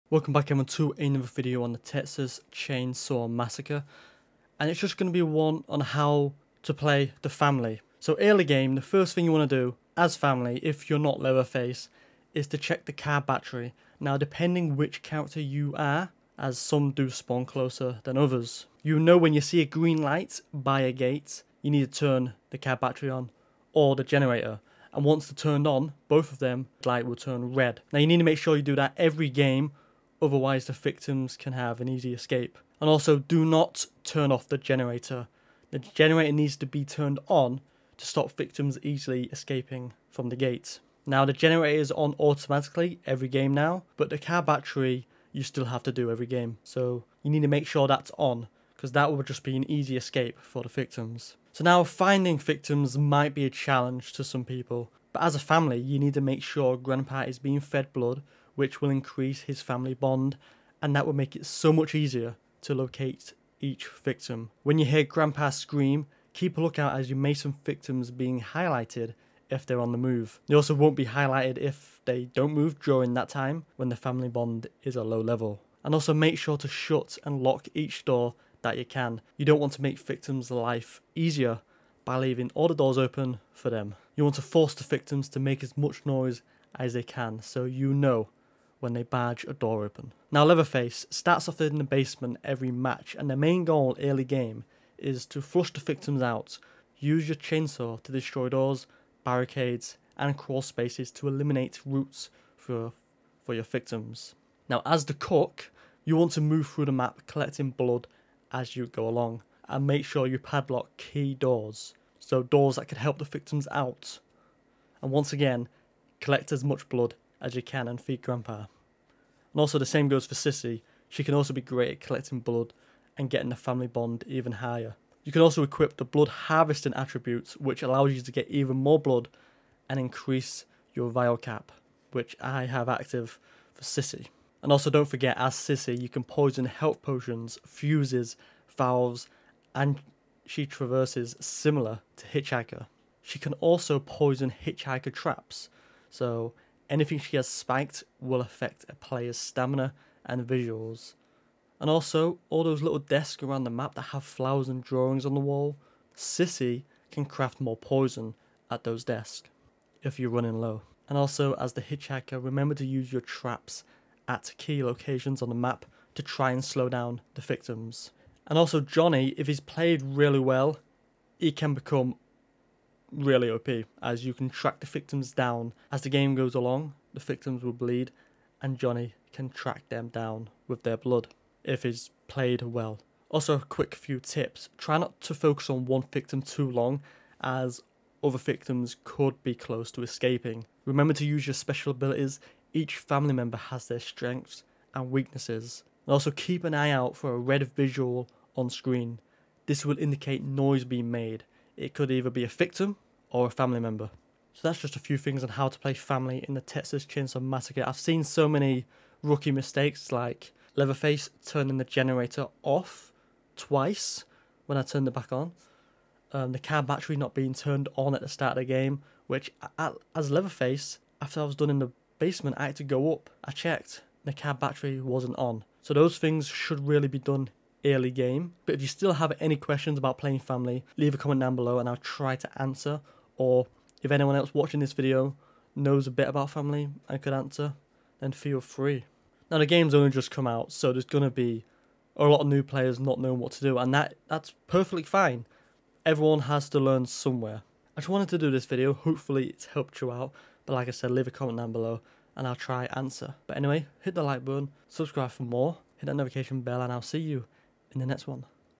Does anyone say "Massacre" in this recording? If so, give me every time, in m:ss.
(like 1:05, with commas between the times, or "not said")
0:03, 3:27.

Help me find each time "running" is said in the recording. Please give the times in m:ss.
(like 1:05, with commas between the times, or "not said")
2:40.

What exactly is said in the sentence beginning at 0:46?
So you need to make sure that's on, because that would just be an easy escape for the victims.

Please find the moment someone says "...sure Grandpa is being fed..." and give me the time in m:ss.
0:56.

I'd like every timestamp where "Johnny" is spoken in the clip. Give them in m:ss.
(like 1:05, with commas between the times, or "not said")
2:48, 2:58.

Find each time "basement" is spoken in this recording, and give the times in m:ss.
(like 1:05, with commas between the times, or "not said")
1:31, 3:42.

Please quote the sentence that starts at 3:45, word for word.
So those things should really be done early game.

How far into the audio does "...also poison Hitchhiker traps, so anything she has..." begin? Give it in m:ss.
2:23.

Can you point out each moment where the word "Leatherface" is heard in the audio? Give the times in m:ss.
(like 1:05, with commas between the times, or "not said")
0:11, 1:30, 3:30, 3:40.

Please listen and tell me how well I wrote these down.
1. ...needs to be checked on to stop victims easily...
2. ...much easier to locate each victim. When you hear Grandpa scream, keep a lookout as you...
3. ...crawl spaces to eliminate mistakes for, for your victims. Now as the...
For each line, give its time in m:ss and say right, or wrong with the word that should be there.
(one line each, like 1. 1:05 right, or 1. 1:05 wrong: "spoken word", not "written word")
1. 0:36 wrong: "turned", not "checked"
2. 1:01 right
3. 1:40 wrong: "routes", not "mistakes".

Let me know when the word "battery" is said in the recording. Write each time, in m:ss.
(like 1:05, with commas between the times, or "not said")
0:13, 0:22, 0:44, 3:36, 3:44.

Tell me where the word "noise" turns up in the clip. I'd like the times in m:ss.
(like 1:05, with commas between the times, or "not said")
1:26, 3:20.